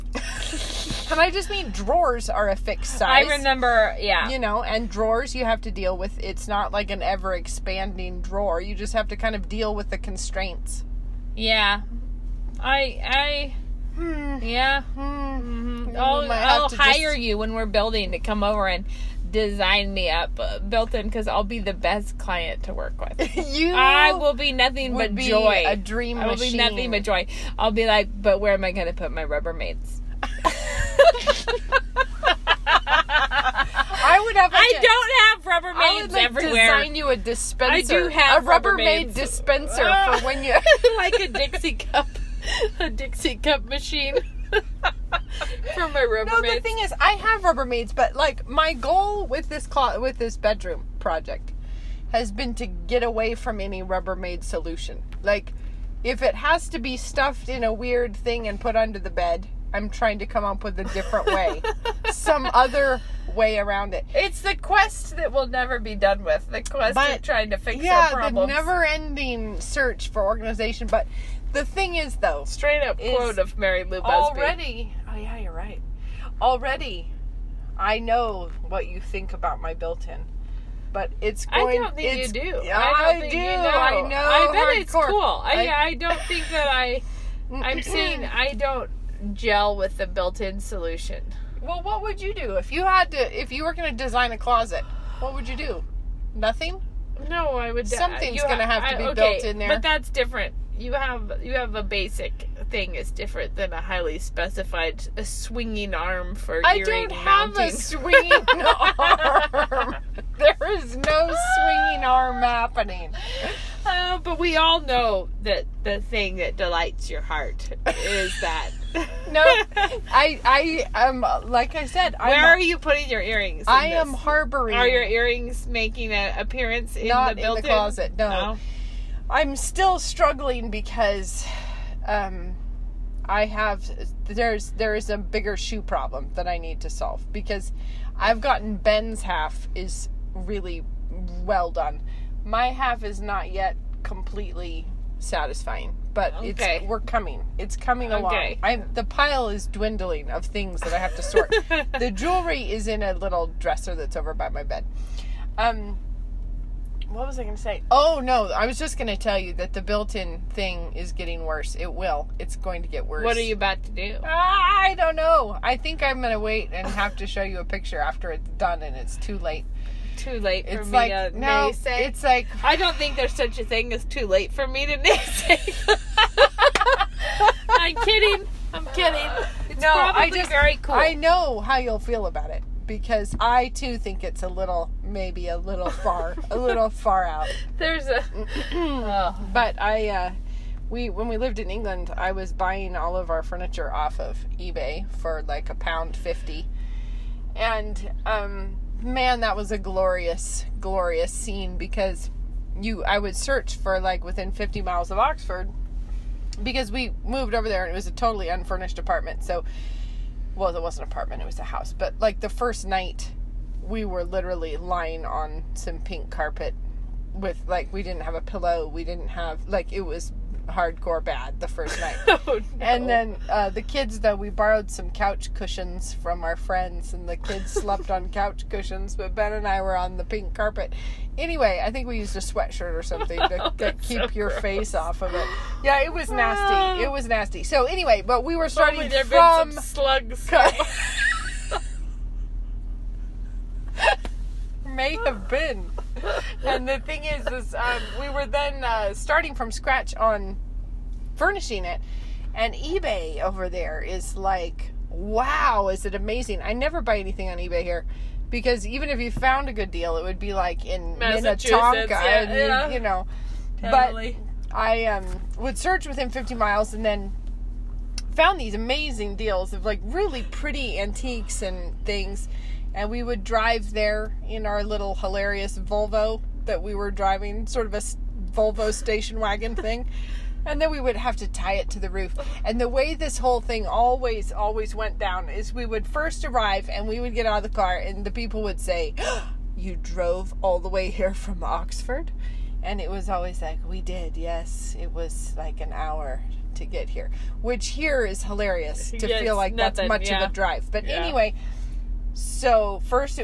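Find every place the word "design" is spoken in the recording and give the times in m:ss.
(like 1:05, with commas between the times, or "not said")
0:19, 0:36, 1:34.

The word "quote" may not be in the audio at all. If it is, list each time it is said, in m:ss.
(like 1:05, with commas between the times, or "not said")
1:12.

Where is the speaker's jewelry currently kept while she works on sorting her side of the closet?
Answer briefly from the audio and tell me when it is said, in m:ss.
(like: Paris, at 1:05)
A little dresser, at 2:33.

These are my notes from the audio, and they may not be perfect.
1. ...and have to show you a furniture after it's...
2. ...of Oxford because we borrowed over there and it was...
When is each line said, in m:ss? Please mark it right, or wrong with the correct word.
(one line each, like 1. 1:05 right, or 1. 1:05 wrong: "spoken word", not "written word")
1. 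2:46 wrong: "picture", not "furniture"
2. 3:25 wrong: "moved", not "borrowed".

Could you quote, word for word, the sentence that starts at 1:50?
There is no swinging arm happening.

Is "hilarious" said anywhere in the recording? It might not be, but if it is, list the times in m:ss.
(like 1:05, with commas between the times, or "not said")
4:35, 4:58.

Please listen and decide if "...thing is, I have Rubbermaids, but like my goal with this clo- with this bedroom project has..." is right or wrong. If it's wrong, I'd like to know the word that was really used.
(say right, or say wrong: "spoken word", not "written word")
right.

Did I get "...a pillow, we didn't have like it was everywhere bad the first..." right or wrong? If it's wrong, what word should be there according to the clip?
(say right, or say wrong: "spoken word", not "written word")
wrong: "hardcore", not "everywhere".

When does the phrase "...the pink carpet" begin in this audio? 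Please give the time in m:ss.
3:50.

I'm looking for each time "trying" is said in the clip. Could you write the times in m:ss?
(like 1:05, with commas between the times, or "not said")
0:59, 1:07.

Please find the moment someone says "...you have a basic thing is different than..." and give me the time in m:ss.
1:41.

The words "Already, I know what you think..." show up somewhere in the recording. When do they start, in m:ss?
1:16.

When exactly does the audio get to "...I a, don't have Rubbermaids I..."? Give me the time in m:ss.
0:34.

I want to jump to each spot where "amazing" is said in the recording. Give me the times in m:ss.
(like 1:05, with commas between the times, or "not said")
4:16, 4:28.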